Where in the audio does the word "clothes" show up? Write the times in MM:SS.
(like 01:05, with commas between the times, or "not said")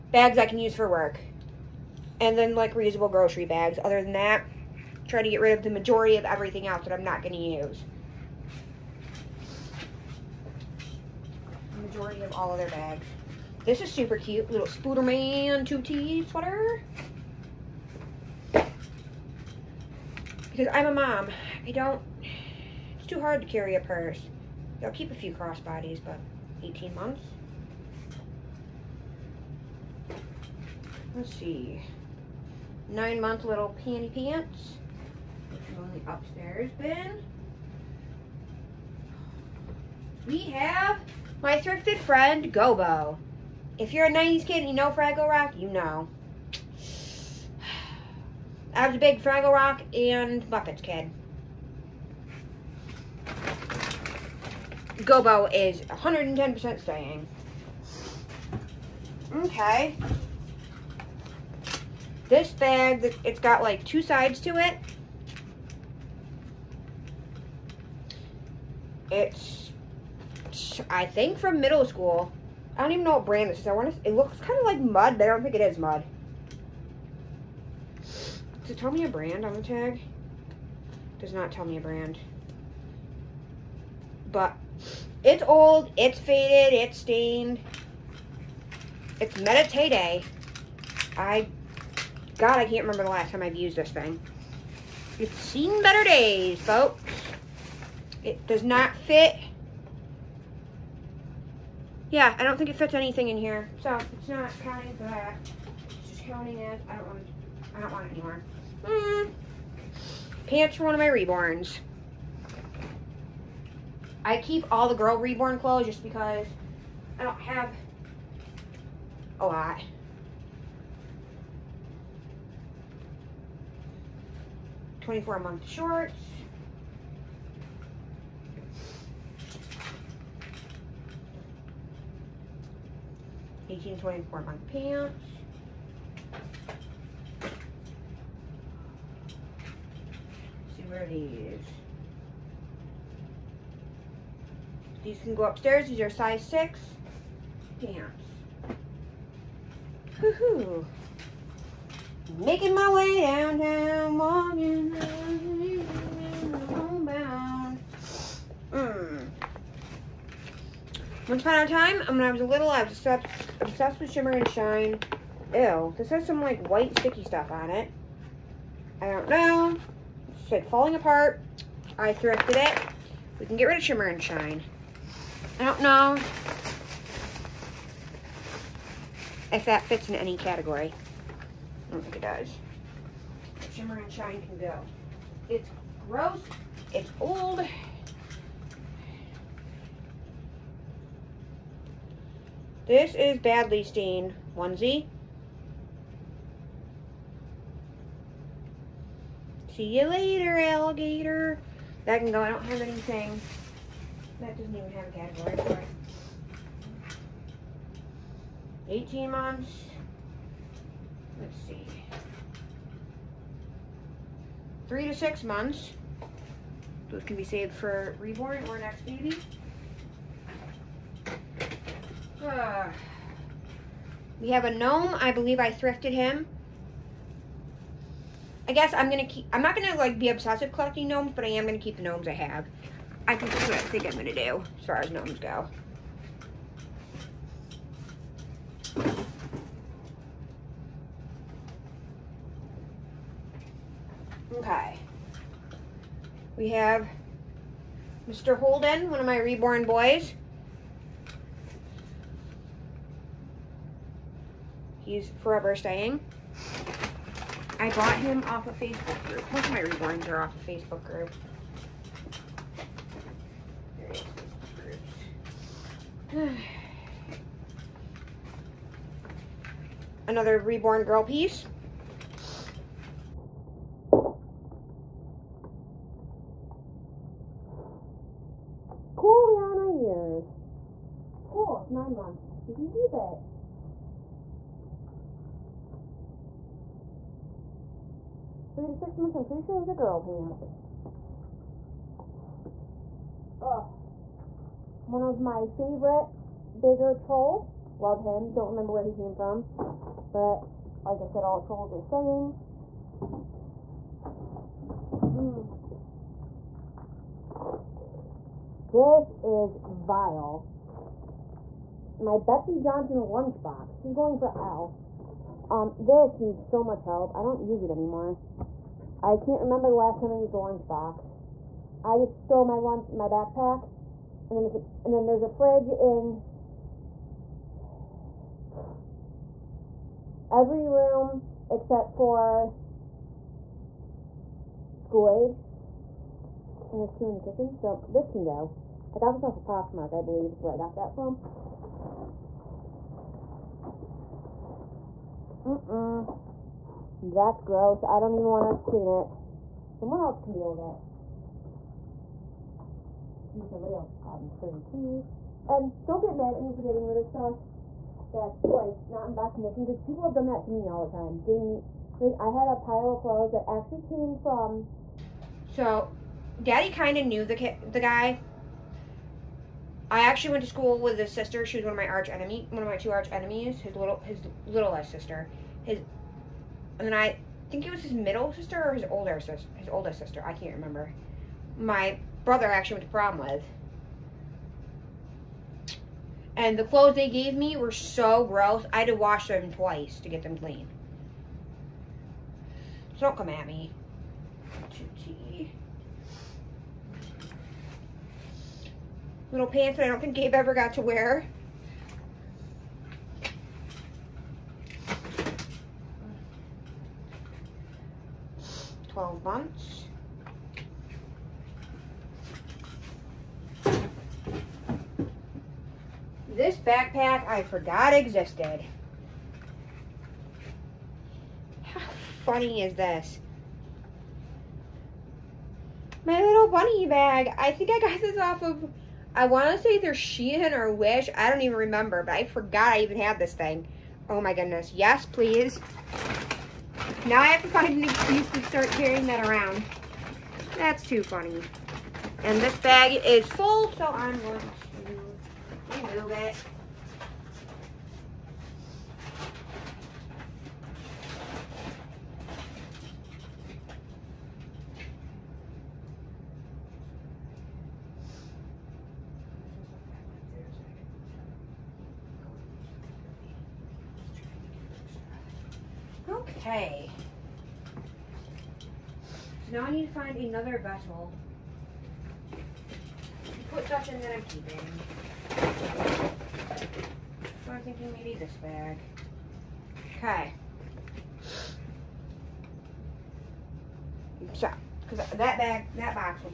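01:55, 06:03, 06:26.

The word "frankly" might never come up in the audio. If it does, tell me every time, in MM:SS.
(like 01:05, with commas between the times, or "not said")
not said.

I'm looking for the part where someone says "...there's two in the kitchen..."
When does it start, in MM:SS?
05:36.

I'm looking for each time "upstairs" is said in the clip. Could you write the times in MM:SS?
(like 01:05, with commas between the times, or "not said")
00:36, 02:25.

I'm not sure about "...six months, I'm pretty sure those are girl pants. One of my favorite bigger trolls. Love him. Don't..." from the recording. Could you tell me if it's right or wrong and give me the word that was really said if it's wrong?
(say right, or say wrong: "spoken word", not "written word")
right.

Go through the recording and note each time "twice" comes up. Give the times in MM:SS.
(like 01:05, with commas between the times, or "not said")
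06:29.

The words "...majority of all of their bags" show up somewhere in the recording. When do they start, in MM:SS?
00:11.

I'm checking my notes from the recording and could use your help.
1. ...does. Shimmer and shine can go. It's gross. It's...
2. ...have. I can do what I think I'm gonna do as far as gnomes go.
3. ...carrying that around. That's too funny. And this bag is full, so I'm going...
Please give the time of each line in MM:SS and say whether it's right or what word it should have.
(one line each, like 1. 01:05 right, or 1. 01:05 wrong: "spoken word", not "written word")
1. 03:02 right
2. 03:52 right
3. 07:18 right.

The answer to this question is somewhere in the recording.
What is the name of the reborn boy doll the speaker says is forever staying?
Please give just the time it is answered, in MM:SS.
04:08.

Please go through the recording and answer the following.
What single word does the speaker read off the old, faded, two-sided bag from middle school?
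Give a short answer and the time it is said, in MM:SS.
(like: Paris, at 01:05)
Meditate, at 01:29.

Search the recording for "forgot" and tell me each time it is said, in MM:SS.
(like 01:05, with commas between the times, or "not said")
06:57, 07:12.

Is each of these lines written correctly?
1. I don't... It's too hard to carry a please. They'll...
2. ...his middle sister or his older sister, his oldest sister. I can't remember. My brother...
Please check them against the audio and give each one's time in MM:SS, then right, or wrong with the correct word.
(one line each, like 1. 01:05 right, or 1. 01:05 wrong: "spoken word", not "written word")
1. 00:21 wrong: "purse", not "please"
2. 06:18 right.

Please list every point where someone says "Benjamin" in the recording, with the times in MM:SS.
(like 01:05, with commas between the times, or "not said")
not said.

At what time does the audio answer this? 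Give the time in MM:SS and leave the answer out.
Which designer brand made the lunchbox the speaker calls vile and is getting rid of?
05:12.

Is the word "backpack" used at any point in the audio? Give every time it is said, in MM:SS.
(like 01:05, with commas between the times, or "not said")
05:23, 06:56.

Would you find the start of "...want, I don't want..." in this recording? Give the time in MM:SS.
01:47.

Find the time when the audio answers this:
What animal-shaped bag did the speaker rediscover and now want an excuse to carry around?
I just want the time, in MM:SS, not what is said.
07:06.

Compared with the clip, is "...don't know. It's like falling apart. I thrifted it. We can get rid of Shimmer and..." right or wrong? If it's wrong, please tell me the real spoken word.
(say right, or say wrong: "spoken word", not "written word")
right.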